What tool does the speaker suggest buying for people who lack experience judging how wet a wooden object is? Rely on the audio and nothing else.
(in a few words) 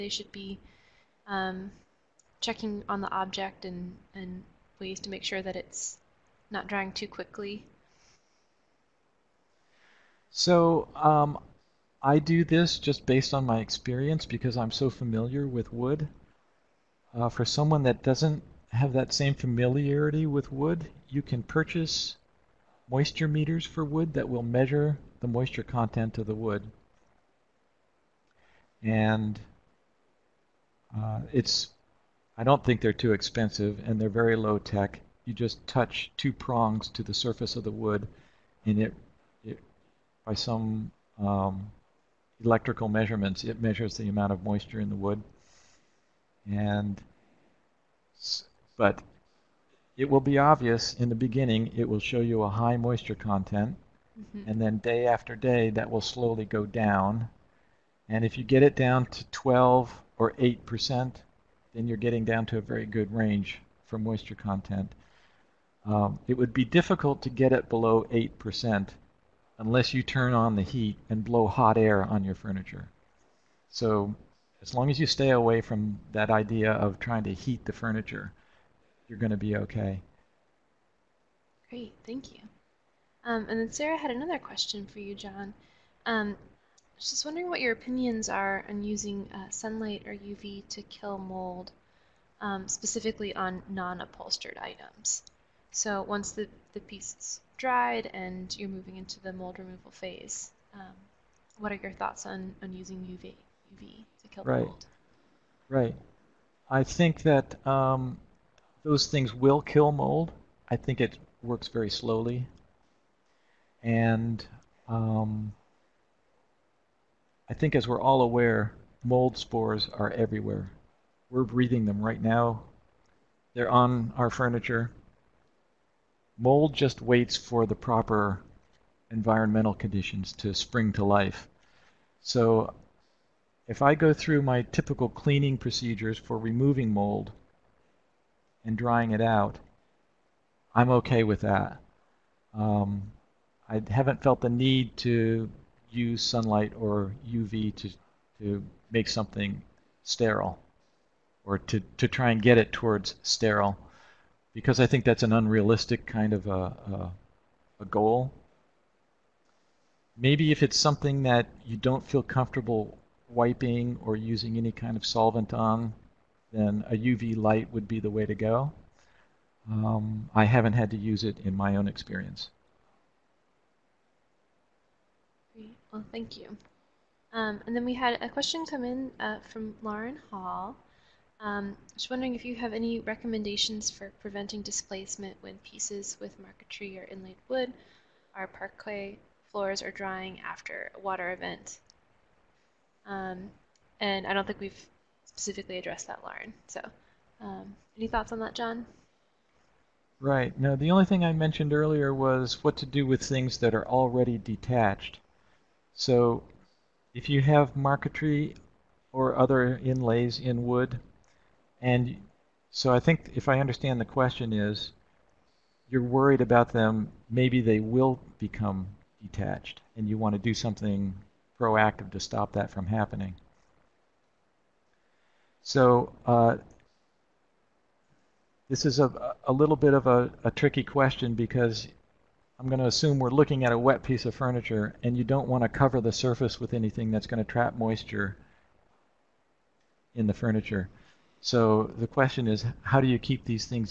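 moisture meters.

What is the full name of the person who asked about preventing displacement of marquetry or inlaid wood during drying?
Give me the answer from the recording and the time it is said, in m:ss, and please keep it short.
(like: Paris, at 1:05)
Lauren Hall, at 2:59.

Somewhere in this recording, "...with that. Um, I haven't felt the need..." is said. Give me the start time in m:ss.
2:21.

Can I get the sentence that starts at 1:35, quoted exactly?
So once the, the piece dried and you're moving into the mold removal phase.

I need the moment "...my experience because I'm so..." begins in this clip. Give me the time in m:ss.
0:13.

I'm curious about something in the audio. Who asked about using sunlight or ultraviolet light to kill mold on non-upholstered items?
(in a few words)
Sarah.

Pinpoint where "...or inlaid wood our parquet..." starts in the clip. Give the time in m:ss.
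3:06.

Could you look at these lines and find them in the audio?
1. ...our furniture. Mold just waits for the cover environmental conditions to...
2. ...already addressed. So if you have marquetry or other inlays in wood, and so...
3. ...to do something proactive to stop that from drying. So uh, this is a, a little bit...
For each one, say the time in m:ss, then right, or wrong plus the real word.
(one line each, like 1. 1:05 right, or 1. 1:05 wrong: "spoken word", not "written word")
1. 2:04 wrong: "proper", not "cover"
2. 3:23 wrong: "detached", not "addressed"
3. 3:40 wrong: "happening", not "drying".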